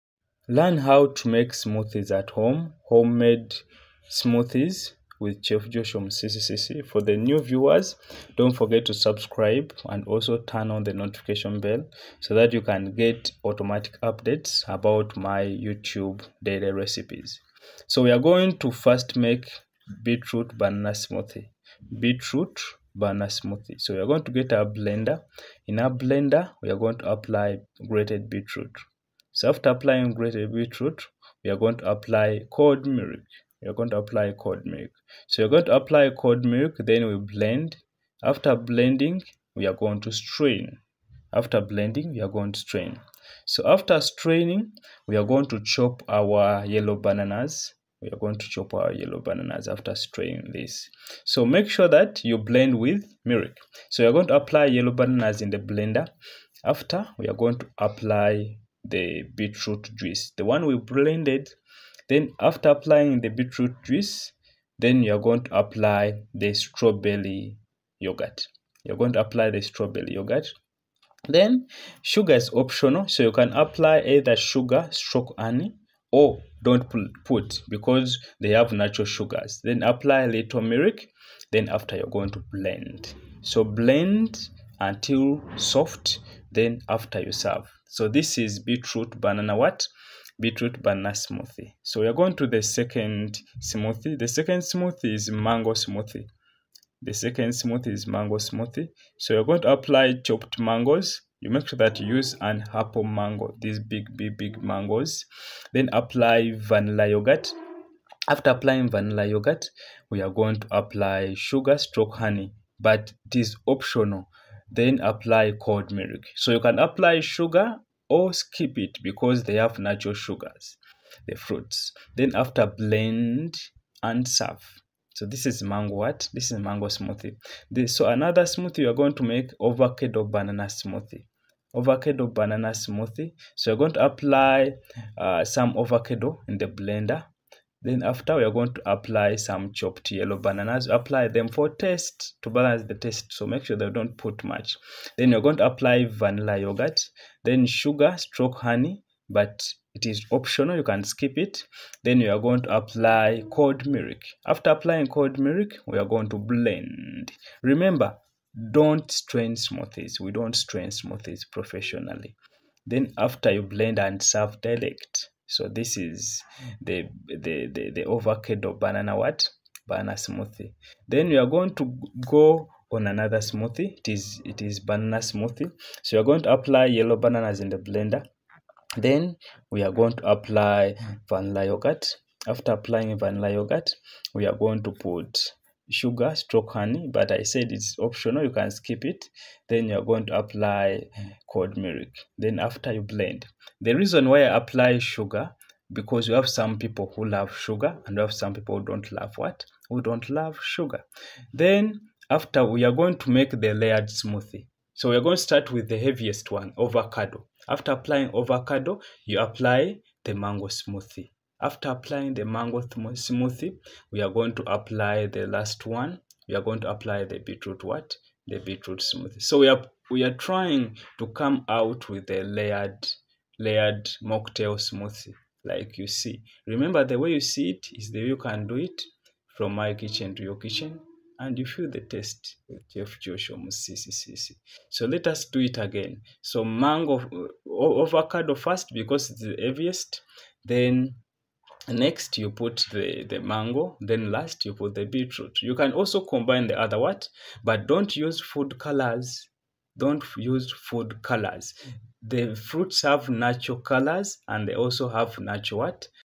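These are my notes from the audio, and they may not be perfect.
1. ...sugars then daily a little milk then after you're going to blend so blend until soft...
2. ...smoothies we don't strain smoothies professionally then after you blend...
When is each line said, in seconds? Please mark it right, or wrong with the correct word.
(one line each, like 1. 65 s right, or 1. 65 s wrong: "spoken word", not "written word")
1. 79 s wrong: "apply", not "daily"
2. 159 s right.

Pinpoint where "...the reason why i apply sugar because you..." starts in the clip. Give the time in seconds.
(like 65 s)
193 s.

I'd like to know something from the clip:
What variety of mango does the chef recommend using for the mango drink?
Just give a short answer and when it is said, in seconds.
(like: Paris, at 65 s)
Apple mango, at 102 s.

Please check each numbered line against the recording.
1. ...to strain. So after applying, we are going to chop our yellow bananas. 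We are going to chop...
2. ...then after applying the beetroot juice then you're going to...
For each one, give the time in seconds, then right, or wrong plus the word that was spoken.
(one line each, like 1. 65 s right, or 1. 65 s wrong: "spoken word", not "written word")
1. 42 s wrong: "straining", not "applying"
2. 62 s right.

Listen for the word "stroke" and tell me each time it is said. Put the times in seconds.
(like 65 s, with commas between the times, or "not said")
74 s, 111 s, 148 s, 186 s.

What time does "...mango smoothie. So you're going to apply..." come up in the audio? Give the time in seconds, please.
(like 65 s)
98 s.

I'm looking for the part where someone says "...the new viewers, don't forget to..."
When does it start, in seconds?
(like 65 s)
7 s.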